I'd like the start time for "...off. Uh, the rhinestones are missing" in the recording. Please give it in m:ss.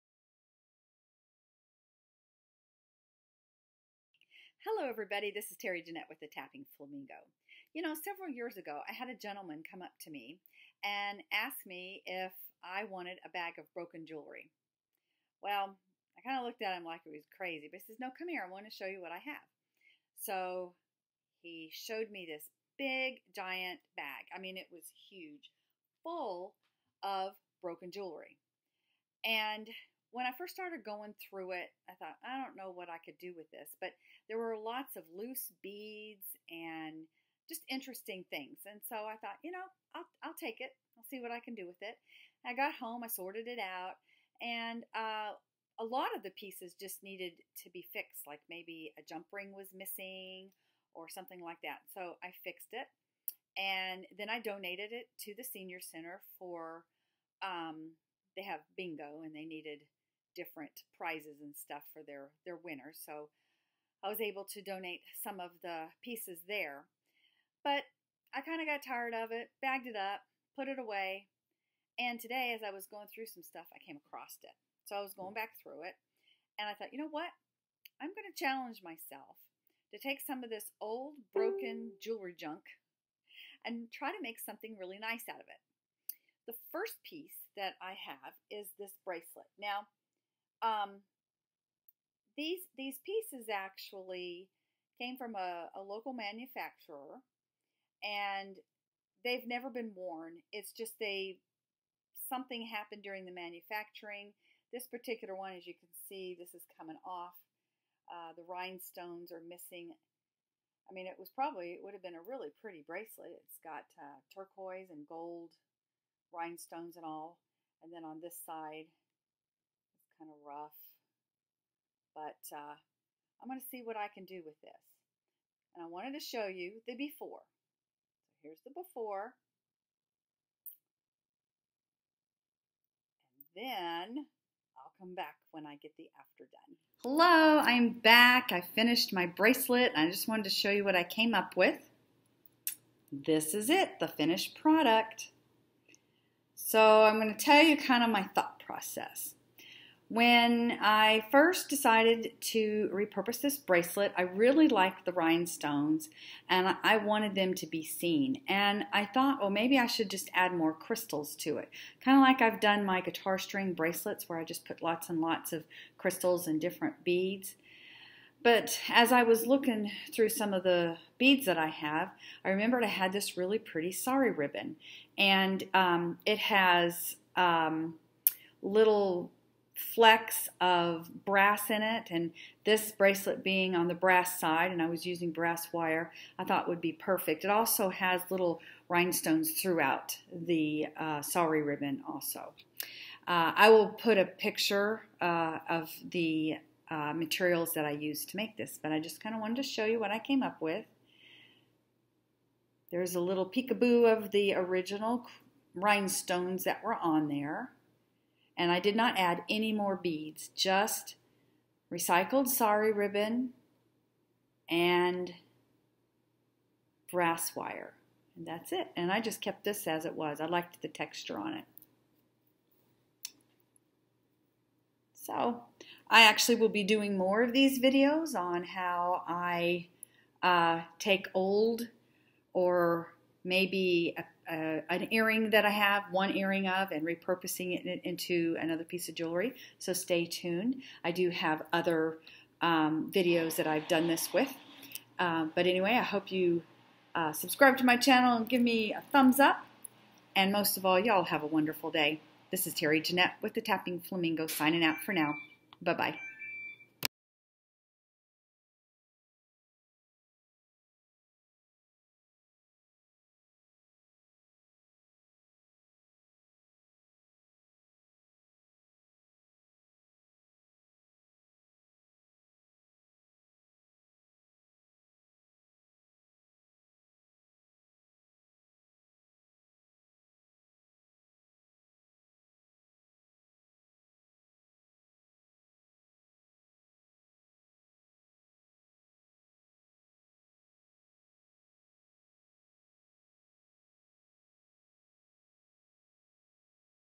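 1:47.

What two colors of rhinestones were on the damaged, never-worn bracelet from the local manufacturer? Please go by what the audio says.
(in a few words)
turquoise and gold.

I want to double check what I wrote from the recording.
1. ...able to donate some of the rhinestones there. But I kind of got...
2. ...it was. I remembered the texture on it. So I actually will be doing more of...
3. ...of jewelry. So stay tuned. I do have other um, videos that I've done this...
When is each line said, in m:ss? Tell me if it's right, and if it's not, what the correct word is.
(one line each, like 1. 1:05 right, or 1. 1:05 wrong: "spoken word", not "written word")
1. 1:04 wrong: "pieces", not "rhinestones"
2. 3:40 wrong: "liked", not "remembered"
3. 3:59 right.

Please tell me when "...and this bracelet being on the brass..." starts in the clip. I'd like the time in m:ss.
3:02.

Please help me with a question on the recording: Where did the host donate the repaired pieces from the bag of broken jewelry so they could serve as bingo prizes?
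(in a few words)
Senior Center.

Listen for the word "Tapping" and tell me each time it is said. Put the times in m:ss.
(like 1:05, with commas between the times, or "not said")
0:06, 4:13.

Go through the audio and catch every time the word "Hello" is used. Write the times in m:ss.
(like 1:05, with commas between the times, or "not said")
0:04, 2:17.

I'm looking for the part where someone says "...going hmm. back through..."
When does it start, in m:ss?
1:15.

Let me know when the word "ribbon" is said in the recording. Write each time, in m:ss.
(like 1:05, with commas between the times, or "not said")
2:54, 3:11, 3:32.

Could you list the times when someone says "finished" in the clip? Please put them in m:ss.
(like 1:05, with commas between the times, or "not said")
2:18, 2:24.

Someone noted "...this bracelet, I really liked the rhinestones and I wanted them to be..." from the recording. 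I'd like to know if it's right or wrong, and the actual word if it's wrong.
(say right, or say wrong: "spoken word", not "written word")
right.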